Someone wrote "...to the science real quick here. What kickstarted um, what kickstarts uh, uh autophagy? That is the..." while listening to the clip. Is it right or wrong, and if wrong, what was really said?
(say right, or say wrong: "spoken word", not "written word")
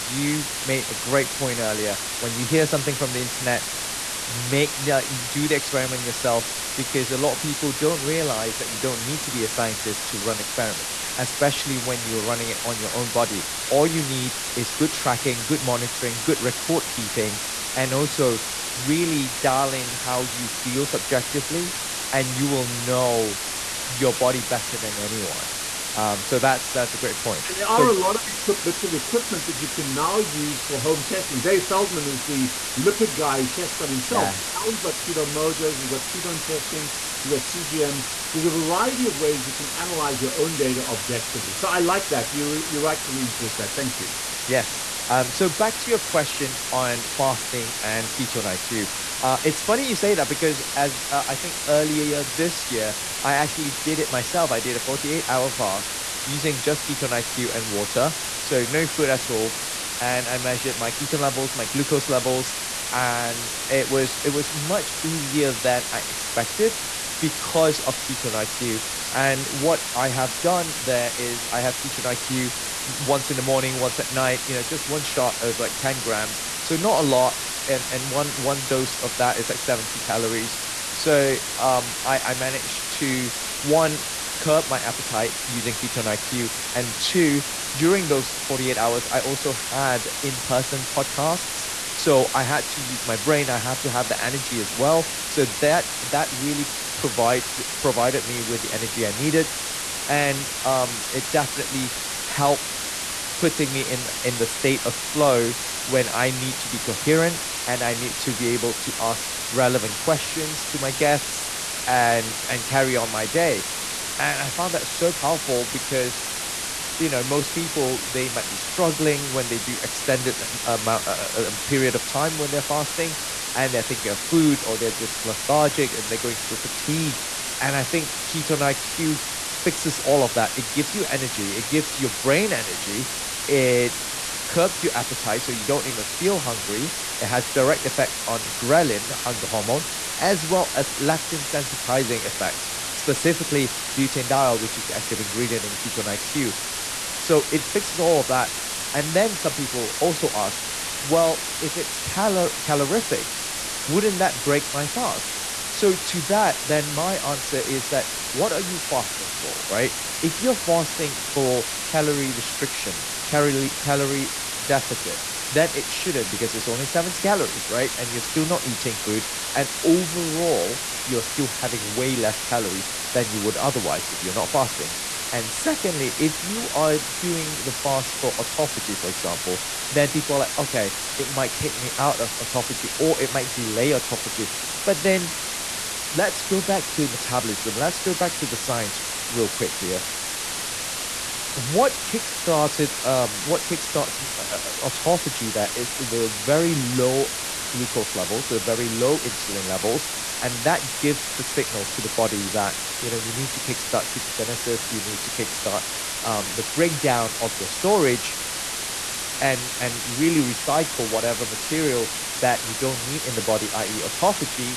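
right.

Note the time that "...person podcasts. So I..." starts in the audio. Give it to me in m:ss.
1:30.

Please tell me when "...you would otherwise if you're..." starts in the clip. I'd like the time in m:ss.
2:53.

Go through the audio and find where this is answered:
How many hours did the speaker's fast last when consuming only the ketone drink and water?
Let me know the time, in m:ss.
0:54.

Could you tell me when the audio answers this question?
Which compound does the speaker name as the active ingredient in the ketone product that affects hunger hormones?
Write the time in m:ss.
2:23.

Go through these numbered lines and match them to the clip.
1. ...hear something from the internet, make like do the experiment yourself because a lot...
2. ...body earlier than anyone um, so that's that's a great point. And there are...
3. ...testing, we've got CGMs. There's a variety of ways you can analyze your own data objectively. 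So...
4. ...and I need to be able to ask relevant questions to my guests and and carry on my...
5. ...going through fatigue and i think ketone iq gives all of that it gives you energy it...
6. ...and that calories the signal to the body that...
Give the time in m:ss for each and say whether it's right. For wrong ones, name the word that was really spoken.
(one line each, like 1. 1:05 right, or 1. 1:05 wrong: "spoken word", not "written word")
1. 0:02 right
2. 0:24 wrong: "better", not "earlier"
3. 0:36 right
4. 1:47 right
5. 2:06 wrong: "fixes", not "gives"
6. 3:20 wrong: "gives", not "calories".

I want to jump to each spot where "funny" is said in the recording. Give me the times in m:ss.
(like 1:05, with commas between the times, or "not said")
0:49.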